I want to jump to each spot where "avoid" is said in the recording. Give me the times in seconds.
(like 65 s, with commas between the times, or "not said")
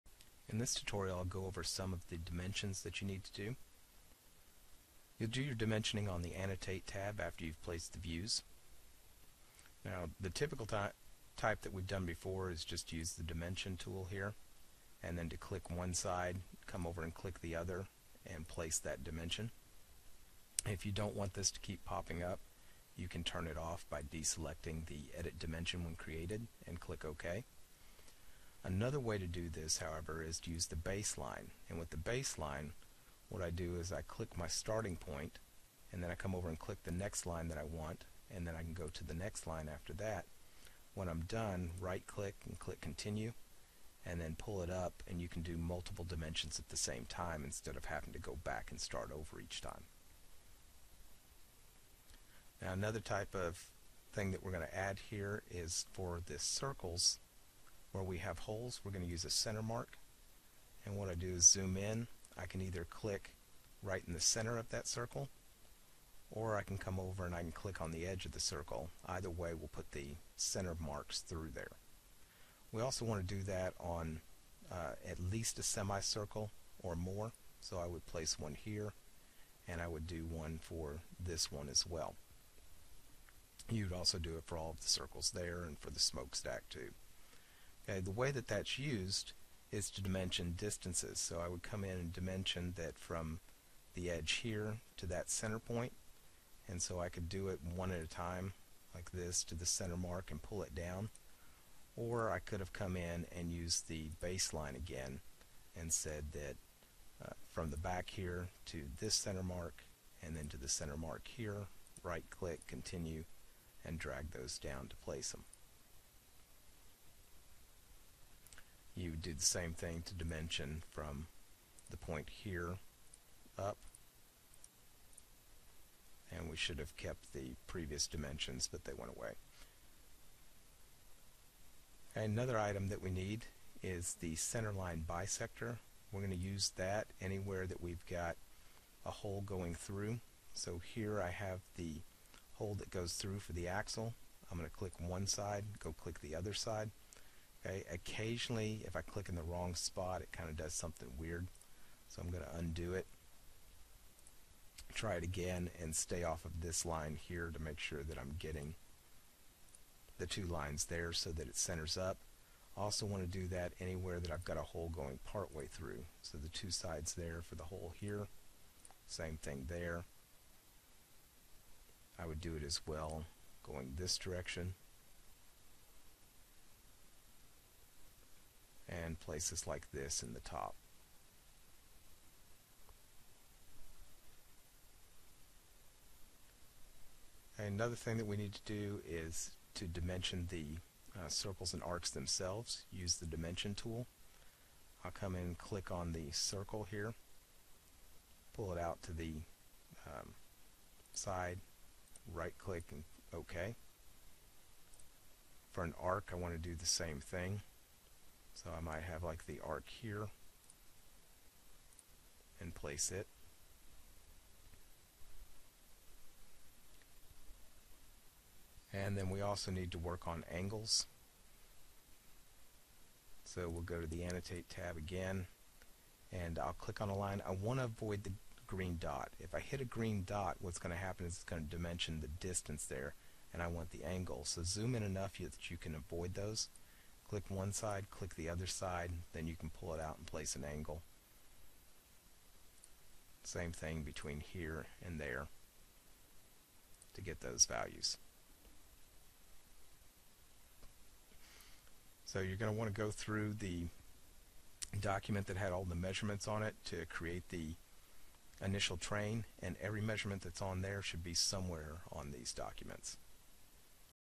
227 s, 235 s.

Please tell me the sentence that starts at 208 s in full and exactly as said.
So I might have like the arc here and place it.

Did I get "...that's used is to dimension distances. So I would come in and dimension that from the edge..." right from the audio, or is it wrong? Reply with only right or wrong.
right.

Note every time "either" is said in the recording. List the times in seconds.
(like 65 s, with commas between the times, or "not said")
62 s, 69 s.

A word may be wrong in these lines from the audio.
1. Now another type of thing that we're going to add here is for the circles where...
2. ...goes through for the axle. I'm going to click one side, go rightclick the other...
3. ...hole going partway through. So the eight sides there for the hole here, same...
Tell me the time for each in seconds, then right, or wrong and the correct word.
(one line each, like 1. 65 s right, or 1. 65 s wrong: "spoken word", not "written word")
1. 52 s right
2. 142 s wrong: "click", not "rightclick"
3. 164 s wrong: "two", not "eight".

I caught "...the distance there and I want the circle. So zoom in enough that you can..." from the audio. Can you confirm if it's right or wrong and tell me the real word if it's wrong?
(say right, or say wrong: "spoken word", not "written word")
wrong: "angle", not "circle".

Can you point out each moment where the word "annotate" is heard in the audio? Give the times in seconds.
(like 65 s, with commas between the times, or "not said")
6 s, 224 s.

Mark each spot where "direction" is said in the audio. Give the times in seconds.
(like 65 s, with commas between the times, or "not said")
174 s.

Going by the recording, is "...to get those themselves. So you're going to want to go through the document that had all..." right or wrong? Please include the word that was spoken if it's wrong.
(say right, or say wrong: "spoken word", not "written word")
wrong: "values", not "themselves".